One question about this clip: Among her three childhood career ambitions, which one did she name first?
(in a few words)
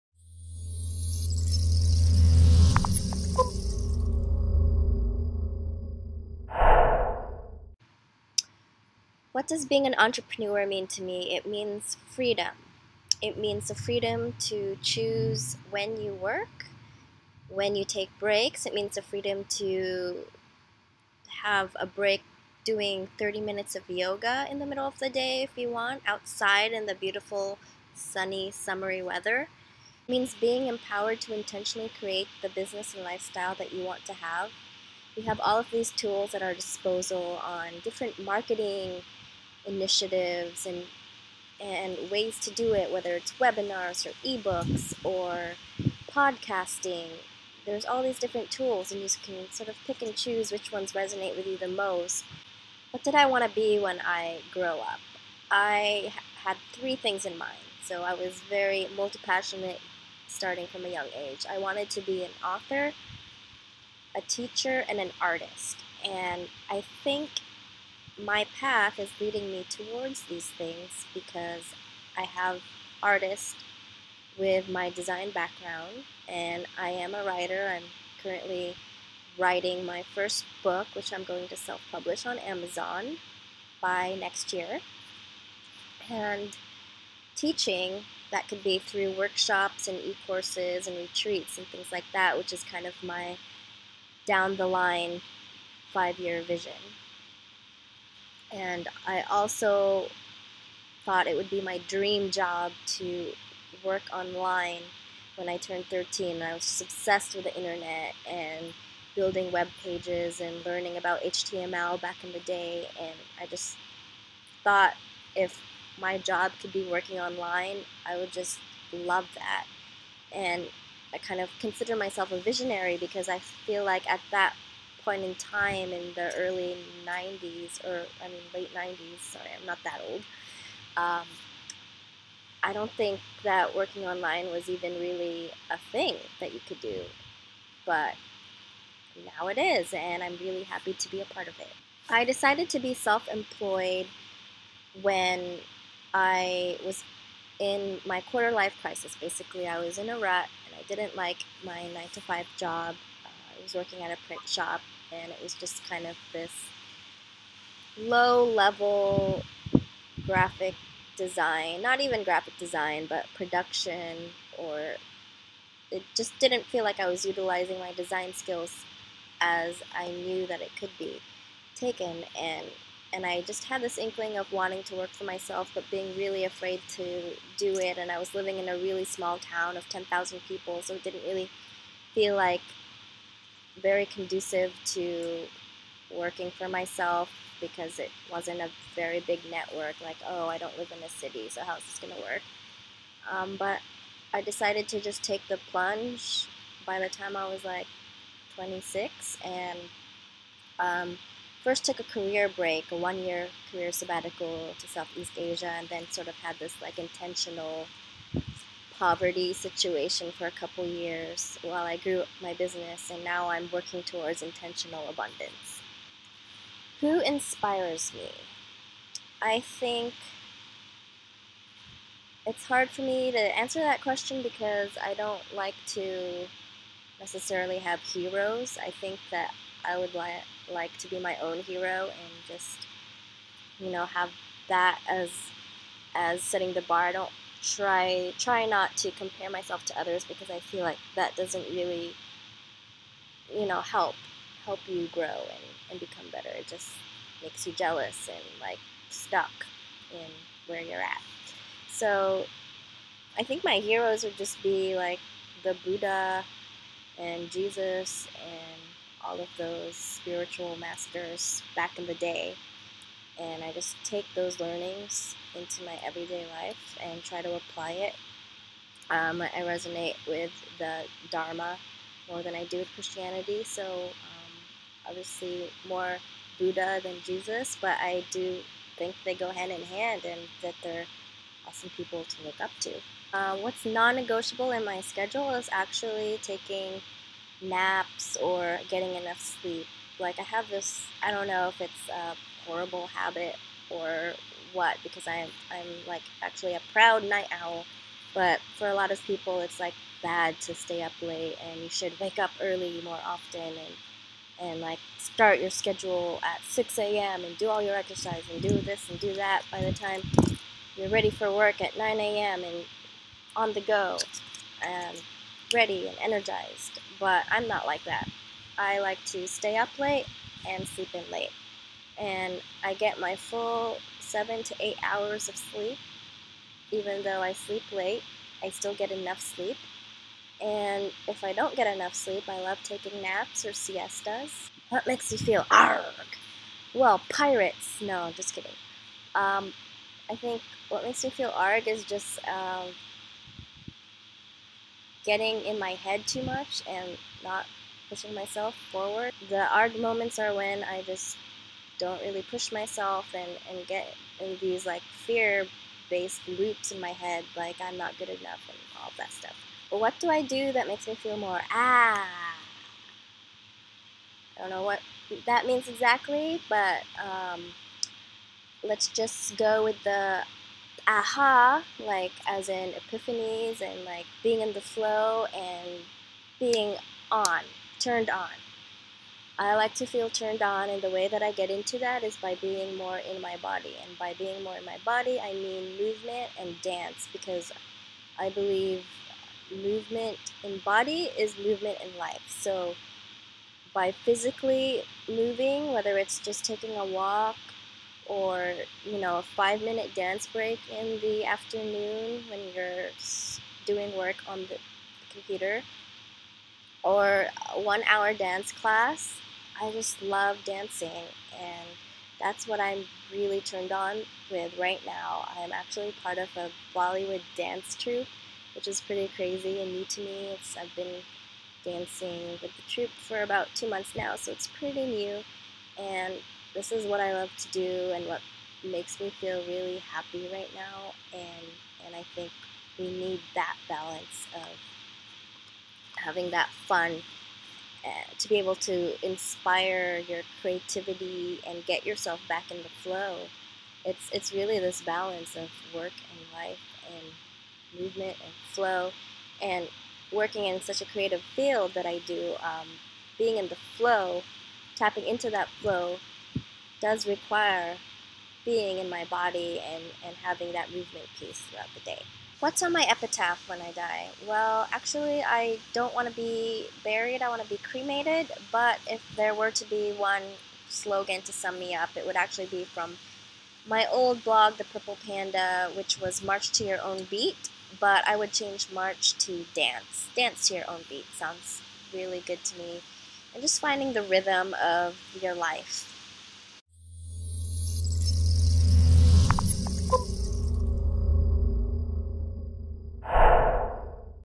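author.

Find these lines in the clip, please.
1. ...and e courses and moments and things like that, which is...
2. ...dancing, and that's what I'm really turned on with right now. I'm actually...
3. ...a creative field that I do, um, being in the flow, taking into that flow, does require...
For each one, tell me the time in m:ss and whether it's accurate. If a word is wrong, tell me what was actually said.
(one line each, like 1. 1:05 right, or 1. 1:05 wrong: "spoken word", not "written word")
1. 1:29 wrong: "retreats", not "moments"
2. 6:50 right
3. 7:31 wrong: "tapping", not "taking".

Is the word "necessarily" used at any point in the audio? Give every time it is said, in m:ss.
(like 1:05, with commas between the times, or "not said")
3:47.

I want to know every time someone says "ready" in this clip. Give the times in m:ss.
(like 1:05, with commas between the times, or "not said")
5:11, 5:15.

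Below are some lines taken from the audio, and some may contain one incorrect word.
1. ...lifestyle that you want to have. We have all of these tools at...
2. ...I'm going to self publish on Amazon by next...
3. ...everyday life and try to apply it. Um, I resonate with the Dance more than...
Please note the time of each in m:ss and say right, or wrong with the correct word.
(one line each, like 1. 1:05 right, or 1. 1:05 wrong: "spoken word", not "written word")
1. 0:33 right
2. 1:21 right
3. 4:26 wrong: "Dharma", not "Dance".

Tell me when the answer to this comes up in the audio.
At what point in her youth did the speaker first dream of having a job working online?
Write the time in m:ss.
1:45.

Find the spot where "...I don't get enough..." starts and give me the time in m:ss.
5:31.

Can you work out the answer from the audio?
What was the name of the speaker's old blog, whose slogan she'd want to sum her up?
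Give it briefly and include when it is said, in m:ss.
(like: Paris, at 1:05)
The Purple Panda, at 7:54.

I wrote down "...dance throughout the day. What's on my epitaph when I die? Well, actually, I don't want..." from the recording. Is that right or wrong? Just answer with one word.
wrong.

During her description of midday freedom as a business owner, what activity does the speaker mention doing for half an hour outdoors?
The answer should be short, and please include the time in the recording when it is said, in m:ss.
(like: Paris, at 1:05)
yoga, at 0:23.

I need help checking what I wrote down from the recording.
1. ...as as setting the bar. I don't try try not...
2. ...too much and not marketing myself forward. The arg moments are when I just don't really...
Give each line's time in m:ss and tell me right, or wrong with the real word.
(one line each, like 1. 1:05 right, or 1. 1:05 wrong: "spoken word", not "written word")
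1. 3:55 right
2. 5:46 wrong: "pushing", not "marketing".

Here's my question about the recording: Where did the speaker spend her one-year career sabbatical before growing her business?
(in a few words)
Southeast Asia.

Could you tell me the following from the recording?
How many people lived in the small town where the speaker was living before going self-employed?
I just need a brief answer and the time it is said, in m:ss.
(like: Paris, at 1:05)
10,000, at 2:59.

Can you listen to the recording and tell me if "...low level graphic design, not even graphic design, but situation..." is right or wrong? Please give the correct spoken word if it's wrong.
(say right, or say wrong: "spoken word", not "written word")
wrong: "production", not "situation".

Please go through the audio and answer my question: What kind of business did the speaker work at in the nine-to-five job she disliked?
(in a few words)
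print shop.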